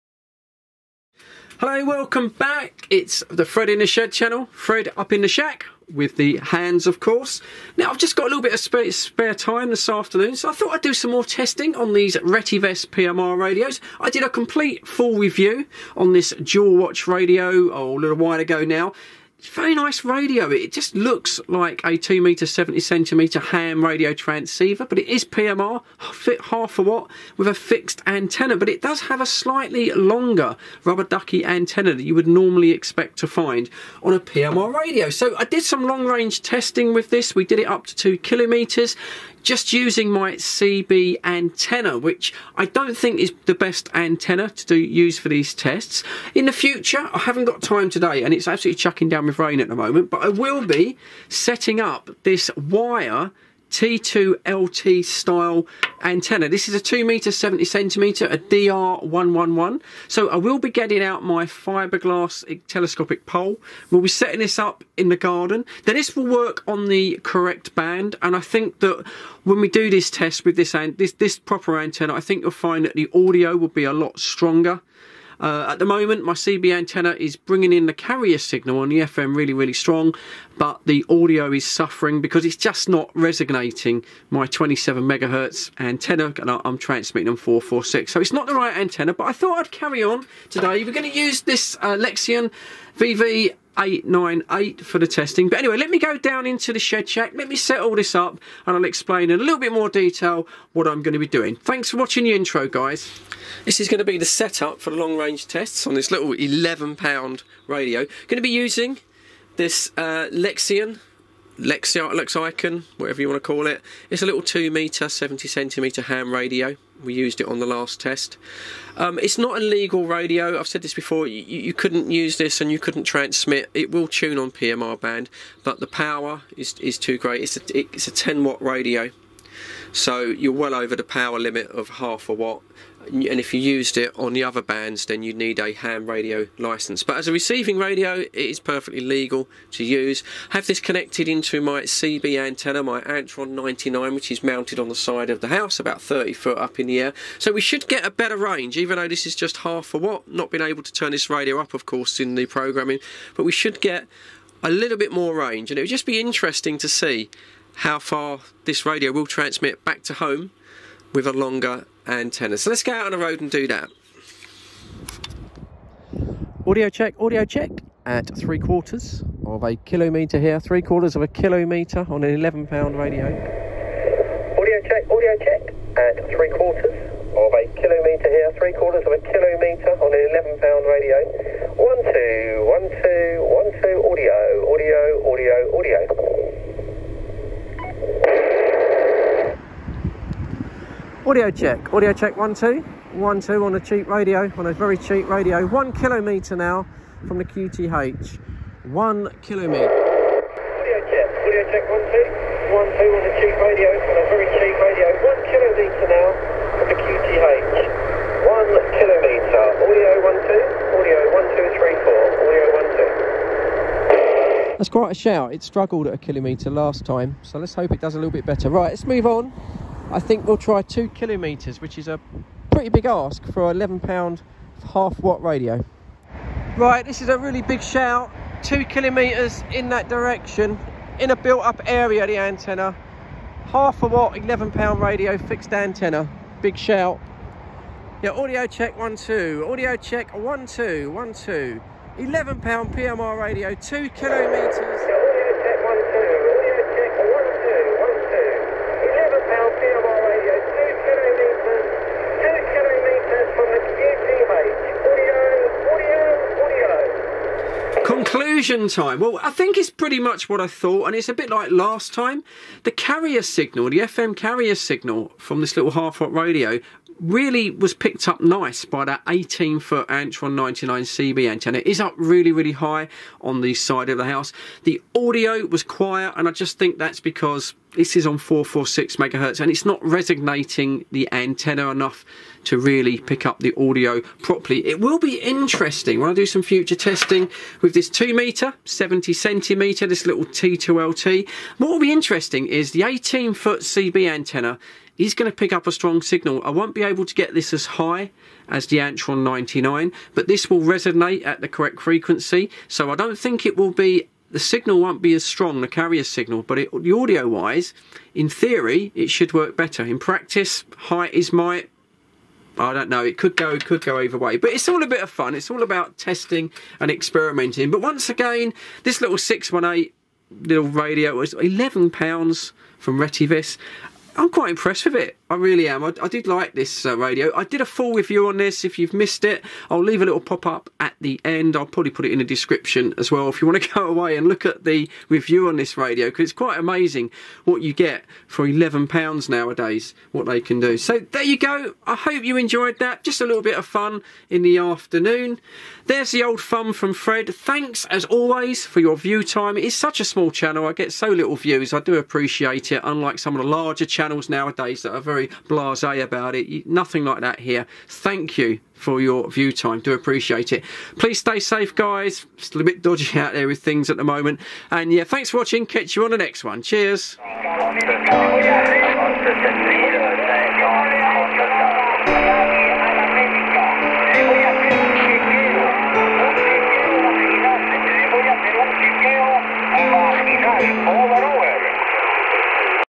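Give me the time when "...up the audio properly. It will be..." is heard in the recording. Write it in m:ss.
4:43.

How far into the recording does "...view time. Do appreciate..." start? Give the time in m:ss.
5:59.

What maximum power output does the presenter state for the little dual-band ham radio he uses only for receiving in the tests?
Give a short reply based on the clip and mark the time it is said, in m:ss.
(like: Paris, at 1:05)
10 watts, at 2:08.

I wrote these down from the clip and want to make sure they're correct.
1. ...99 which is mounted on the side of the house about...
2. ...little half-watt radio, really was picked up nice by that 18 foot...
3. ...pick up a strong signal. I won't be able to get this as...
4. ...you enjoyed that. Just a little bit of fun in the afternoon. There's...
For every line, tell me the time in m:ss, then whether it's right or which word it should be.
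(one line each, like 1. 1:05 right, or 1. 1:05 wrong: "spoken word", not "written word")
1. 2:23 right
2. 4:25 right
3. 4:55 right
4. 5:42 right.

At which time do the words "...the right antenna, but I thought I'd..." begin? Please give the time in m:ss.
1:28.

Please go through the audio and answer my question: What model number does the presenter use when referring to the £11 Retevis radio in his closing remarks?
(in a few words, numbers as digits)
618.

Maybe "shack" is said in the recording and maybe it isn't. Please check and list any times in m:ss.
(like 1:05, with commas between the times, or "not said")
0:05, 1:37.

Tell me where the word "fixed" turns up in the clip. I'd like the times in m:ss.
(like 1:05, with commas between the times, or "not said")
0:27, 3:55.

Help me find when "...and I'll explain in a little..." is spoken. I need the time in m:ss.
1:38.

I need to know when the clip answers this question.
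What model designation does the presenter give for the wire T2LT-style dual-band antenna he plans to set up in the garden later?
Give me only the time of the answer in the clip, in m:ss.
0:58.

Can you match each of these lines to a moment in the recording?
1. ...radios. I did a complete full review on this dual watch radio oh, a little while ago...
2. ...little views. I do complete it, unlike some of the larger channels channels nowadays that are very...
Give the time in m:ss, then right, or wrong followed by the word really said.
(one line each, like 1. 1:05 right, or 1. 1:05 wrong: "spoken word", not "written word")
1. 0:13 right
2. 5:51 wrong: "appreciate", not "complete".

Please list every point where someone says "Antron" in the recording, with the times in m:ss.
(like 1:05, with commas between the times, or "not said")
2:23, 4:30, 4:58.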